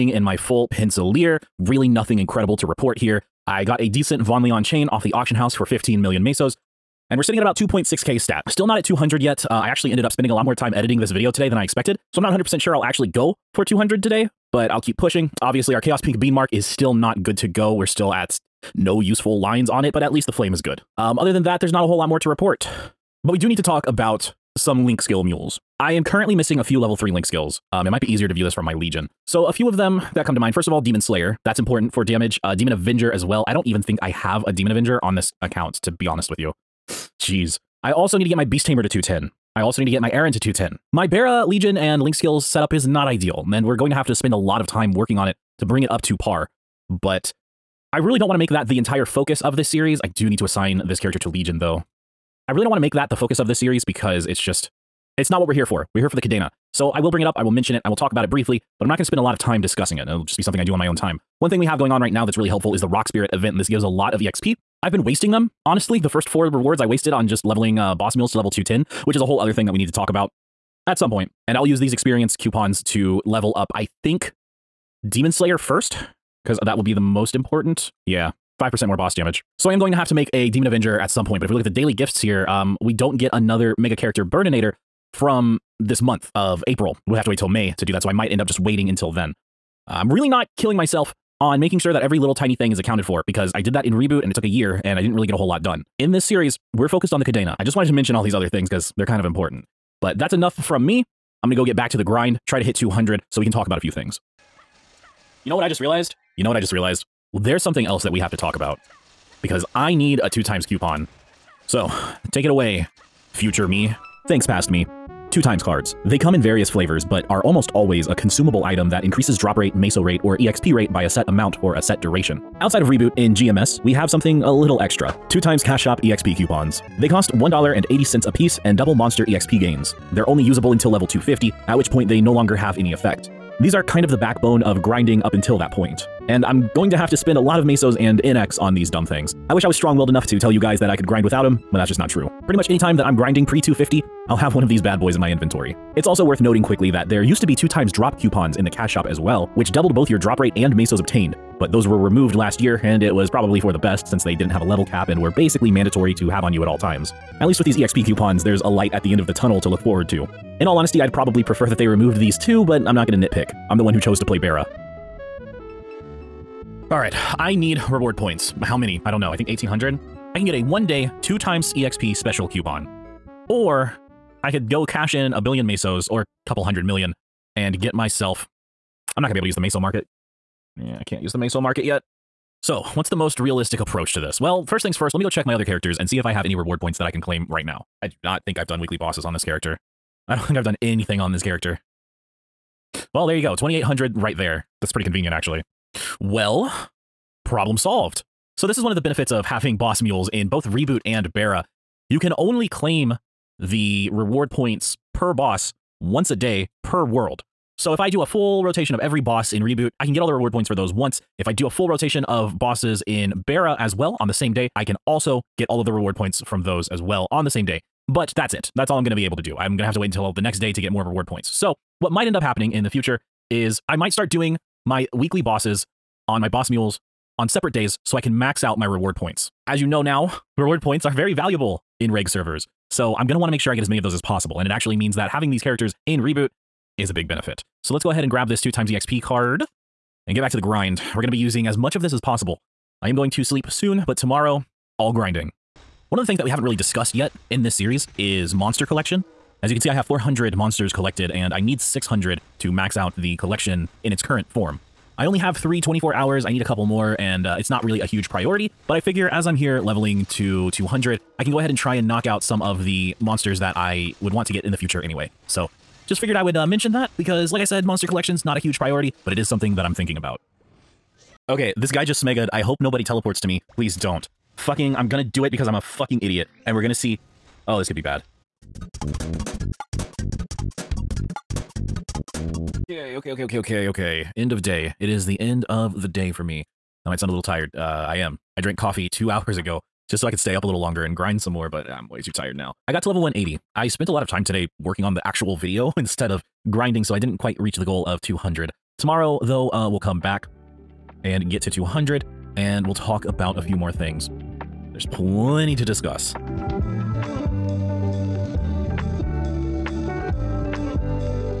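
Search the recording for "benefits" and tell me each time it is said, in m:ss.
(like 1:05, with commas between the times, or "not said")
3:18, 3:57.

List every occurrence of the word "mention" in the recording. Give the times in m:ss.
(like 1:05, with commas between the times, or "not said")
0:57, 1:37, 4:26.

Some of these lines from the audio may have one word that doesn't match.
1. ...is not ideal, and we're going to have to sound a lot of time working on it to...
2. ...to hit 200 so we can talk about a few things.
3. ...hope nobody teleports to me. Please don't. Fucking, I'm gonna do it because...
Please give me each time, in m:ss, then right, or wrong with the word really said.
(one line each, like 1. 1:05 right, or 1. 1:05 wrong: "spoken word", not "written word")
1. 0:42 wrong: "spend", not "sound"
2. 1:42 right
3. 4:32 right.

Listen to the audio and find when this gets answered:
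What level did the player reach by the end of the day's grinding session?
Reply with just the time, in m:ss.
4:53.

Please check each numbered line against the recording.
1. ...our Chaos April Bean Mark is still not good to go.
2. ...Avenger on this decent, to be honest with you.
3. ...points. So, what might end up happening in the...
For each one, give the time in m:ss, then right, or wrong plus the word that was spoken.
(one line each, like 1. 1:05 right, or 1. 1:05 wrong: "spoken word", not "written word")
1. 0:15 wrong: "Pink", not "April"
2. 0:34 wrong: "account", not "decent"
3. 3:41 right.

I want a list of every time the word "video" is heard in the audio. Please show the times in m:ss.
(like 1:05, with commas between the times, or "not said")
0:11, 4:55.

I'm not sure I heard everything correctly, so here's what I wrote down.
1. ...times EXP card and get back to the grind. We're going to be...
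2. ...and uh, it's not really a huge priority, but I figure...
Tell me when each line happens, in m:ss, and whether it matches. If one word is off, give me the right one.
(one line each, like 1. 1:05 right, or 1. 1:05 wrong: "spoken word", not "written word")
1. 3:58 right
2. 4:17 right.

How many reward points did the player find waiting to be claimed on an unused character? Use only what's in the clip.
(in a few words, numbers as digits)
2800.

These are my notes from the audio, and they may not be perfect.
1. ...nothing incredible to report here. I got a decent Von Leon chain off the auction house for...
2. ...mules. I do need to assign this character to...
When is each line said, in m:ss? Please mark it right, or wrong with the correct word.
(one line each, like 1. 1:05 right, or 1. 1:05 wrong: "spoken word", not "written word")
1. 0:01 right
2. 0:49 wrong: "series", not "mules".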